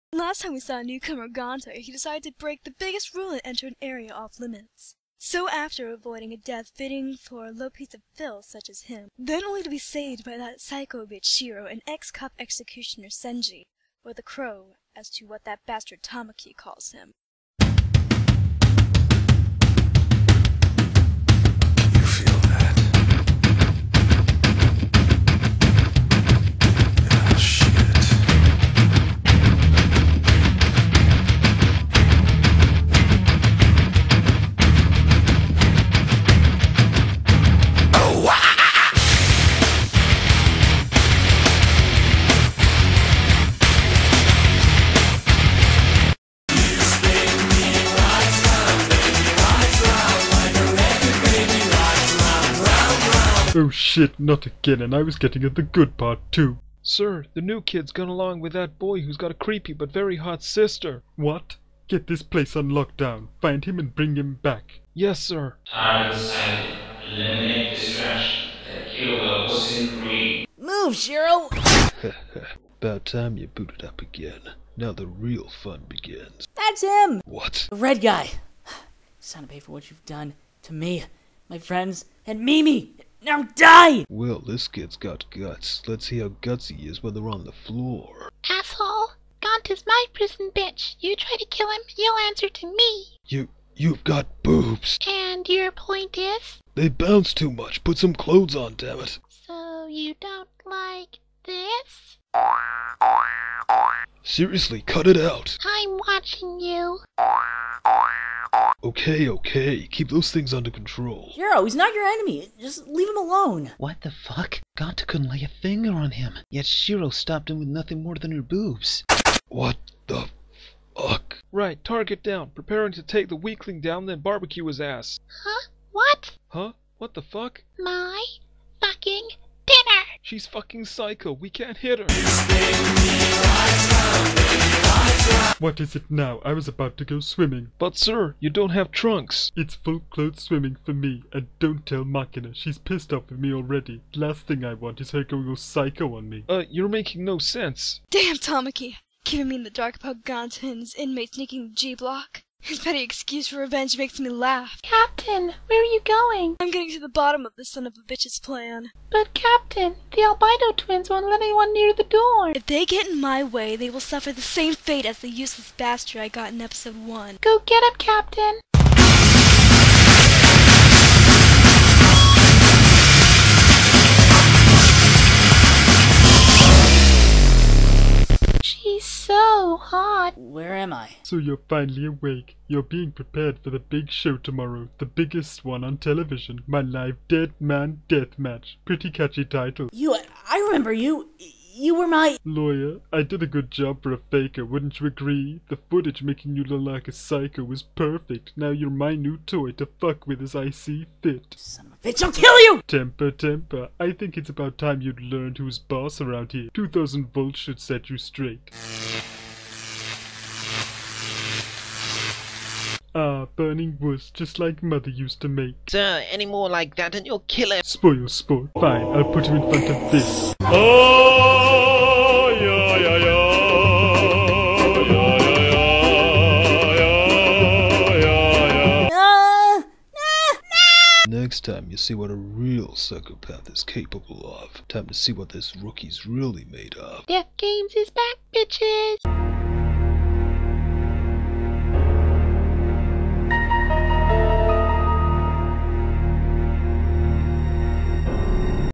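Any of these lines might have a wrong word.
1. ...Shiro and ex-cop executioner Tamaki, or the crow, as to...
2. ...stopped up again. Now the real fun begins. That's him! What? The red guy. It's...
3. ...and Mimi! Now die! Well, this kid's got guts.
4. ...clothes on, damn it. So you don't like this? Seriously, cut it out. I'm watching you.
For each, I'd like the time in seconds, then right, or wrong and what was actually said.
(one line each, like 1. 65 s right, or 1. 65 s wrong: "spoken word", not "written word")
1. 11 s wrong: "Senji", not "Tamaki"
2. 73 s wrong: "booted", not "stopped"
3. 82 s right
4. 98 s right.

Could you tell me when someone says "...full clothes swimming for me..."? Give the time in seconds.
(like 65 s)
139 s.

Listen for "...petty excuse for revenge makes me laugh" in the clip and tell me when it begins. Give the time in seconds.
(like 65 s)
152 s.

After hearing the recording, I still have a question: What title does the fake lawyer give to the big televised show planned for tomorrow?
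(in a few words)
Dead Man Death Match.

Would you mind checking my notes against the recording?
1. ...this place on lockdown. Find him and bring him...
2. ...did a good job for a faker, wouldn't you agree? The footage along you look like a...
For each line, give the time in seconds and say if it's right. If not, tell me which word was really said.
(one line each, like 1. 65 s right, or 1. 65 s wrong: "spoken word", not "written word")
1. 62 s right
2. 193 s wrong: "making", not "along".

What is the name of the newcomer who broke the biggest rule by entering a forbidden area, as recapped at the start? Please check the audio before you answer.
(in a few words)
Arganto.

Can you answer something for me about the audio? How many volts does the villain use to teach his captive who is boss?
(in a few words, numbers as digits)
2000.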